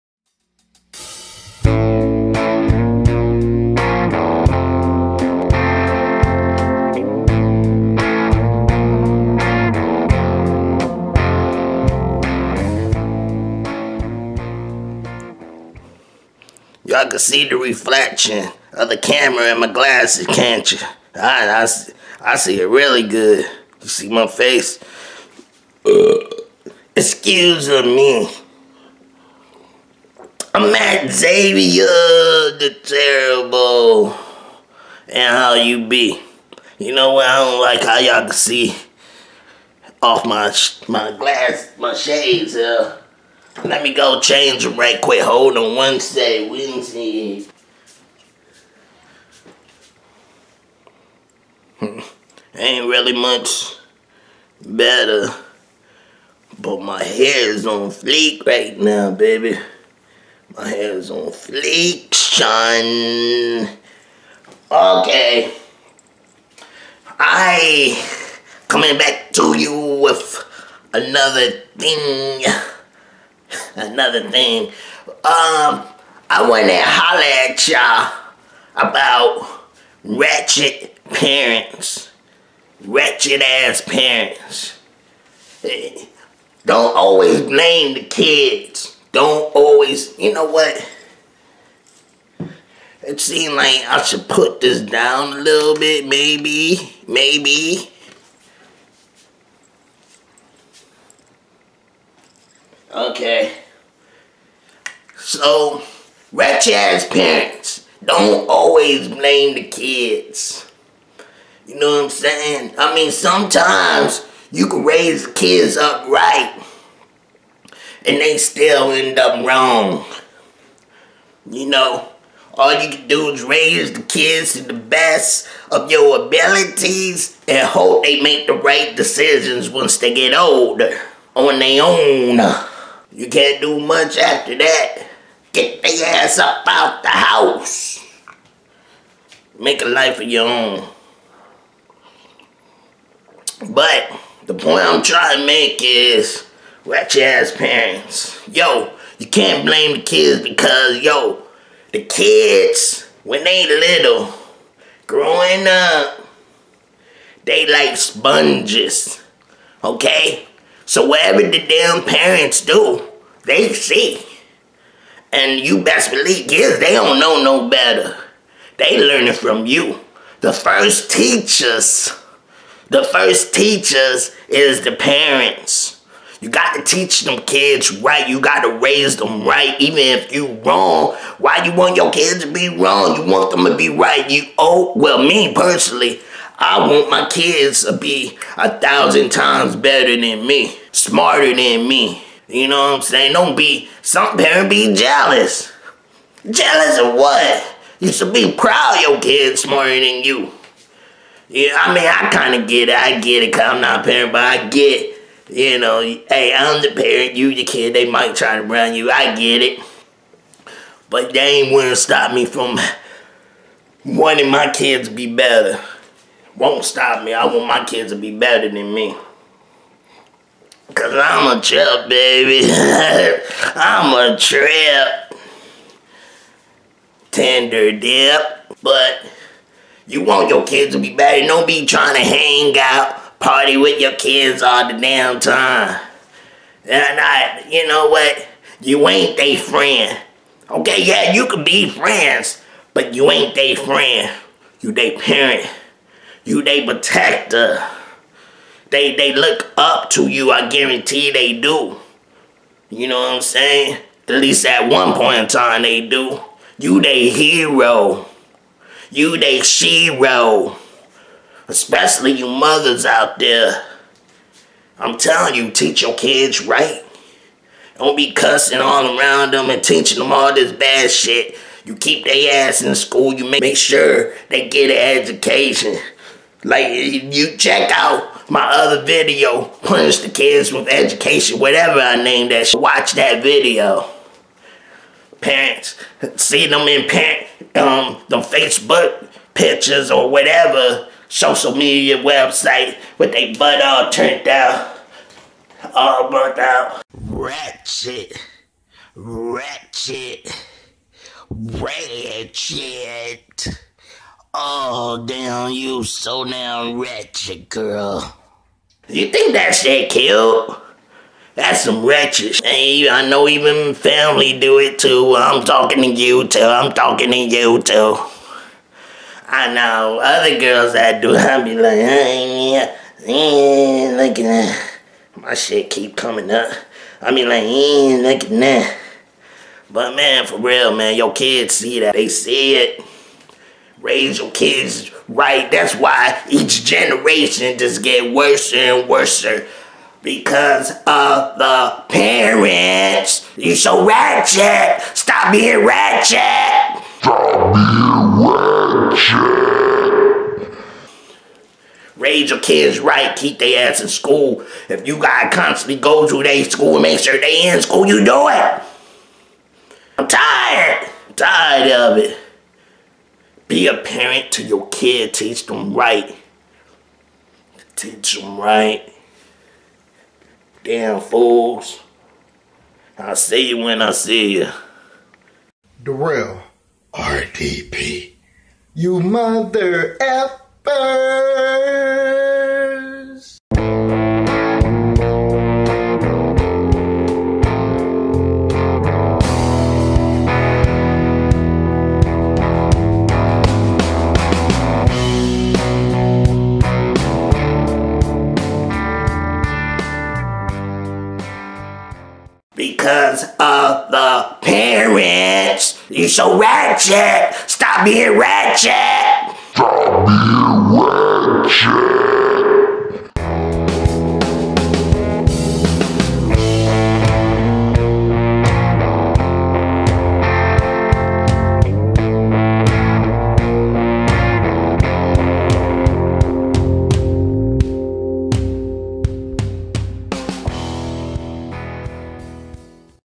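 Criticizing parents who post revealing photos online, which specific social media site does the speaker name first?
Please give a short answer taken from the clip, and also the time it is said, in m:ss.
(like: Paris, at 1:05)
Facebook, at 4:48.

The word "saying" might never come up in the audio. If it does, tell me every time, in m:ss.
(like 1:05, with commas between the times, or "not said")
1:52, 3:13, 4:13.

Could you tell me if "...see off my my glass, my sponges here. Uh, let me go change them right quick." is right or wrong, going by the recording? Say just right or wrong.
wrong.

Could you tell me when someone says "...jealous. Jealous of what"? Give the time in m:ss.
3:14.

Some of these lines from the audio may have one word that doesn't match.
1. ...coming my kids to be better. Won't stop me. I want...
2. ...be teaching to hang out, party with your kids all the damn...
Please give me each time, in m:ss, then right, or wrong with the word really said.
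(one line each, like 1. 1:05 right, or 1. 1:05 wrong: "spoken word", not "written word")
1. 3:34 wrong: "wanting", not "coming"
2. 3:51 wrong: "trying", not "teaching".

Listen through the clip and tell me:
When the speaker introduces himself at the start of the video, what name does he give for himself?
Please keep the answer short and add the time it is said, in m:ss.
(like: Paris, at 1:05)
Matt Xavier Da Terrible, at 0:30.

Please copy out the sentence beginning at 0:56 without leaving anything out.
But my hair is on fleek right now, baby.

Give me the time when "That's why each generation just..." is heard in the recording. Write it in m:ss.
5:35.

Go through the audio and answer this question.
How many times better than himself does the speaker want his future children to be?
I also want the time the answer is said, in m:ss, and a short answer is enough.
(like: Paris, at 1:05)
1000, at 3:08.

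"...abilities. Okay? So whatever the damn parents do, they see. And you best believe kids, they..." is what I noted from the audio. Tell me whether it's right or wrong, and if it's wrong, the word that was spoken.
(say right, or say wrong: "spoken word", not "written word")
wrong: "sponges", not "abilities".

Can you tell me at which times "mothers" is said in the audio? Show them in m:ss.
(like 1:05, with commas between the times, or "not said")
4:22, 6:19.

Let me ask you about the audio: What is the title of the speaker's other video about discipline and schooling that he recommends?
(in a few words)
Punish the Kids with Education.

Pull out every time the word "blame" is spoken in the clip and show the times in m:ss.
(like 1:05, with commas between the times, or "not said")
1:27, 1:49, 2:29.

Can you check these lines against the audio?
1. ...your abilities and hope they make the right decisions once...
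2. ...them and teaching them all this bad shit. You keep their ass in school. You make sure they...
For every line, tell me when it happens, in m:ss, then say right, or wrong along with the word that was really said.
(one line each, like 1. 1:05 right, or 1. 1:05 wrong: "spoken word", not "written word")
1. 2:05 right
2. 4:29 right.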